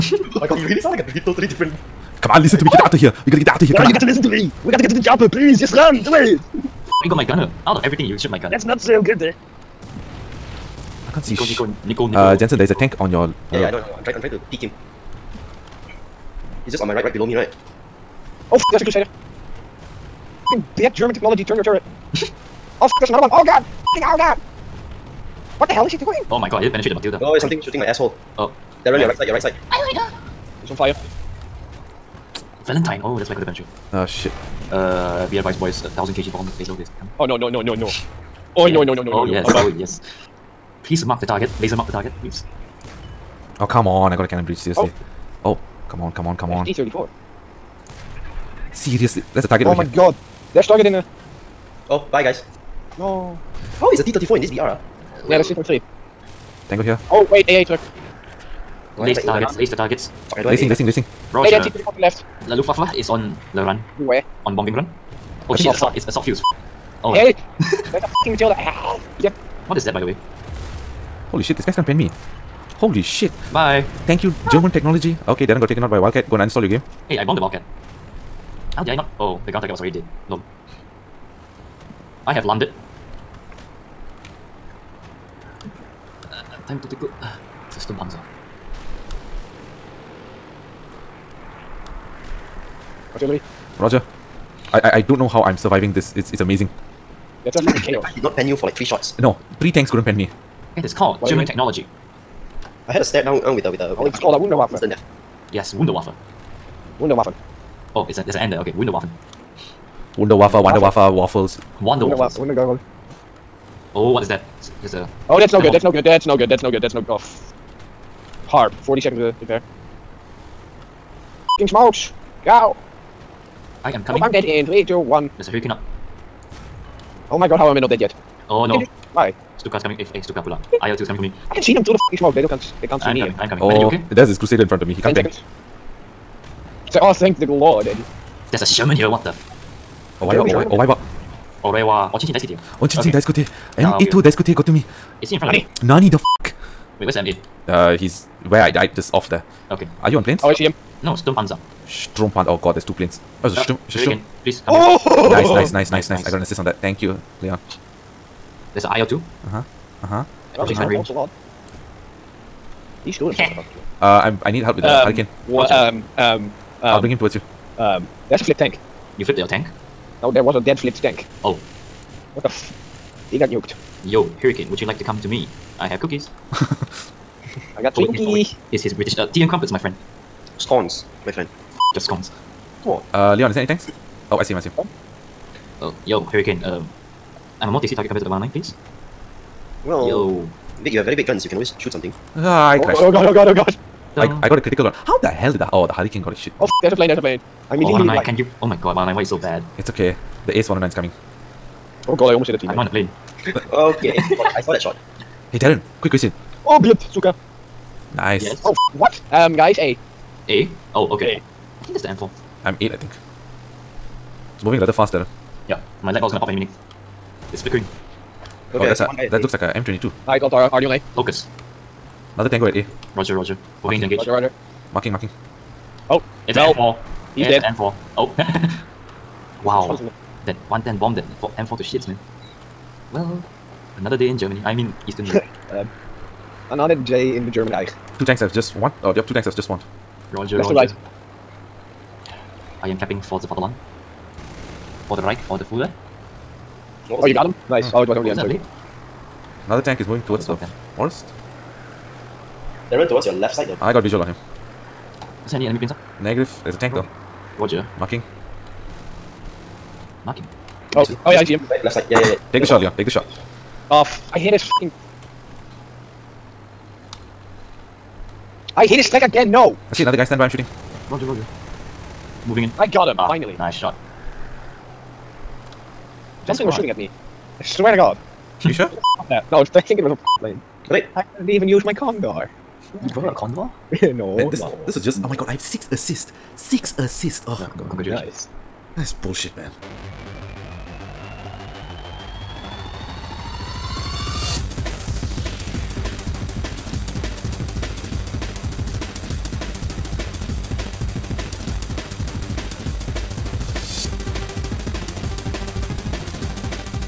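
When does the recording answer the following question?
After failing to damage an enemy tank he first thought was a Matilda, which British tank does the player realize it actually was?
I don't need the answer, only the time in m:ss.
0:32.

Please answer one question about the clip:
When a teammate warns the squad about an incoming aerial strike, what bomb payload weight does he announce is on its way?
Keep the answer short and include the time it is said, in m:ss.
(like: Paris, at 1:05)
1000 kg, at 0:35.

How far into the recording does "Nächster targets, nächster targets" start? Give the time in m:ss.
0:58.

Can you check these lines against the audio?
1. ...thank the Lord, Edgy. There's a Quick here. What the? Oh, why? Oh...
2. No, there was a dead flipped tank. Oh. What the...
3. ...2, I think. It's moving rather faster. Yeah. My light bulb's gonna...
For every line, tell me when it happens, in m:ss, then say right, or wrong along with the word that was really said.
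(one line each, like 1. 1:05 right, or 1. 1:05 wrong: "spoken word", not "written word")
1. 2:17 wrong: "Sherman", not "Quick"
2. 2:50 right
3. 3:32 wrong: "8", not "2".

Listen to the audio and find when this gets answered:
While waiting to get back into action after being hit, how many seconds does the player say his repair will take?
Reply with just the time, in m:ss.
1:58.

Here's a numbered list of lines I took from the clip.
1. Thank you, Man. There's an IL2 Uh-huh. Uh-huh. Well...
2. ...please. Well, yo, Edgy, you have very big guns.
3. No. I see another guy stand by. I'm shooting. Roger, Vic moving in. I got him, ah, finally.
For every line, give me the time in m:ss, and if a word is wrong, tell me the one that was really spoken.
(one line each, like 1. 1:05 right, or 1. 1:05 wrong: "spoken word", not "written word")
1. 2:36 wrong: "Leon", not "Man"
2. 3:08 wrong: "Vic", not "Edgy"
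3. 4:29 wrong: "Roger", not "Vic".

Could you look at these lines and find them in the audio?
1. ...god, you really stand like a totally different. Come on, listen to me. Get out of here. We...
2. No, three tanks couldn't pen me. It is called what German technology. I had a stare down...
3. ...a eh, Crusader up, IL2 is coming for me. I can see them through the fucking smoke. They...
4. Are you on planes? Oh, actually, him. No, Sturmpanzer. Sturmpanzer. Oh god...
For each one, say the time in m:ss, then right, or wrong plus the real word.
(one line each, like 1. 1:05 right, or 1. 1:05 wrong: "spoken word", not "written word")
1. 0:00 wrong: "sound", not "stand"
2. 1:39 right
3. 2:10 wrong: "Stuka", not "Crusader"
4. 2:30 right.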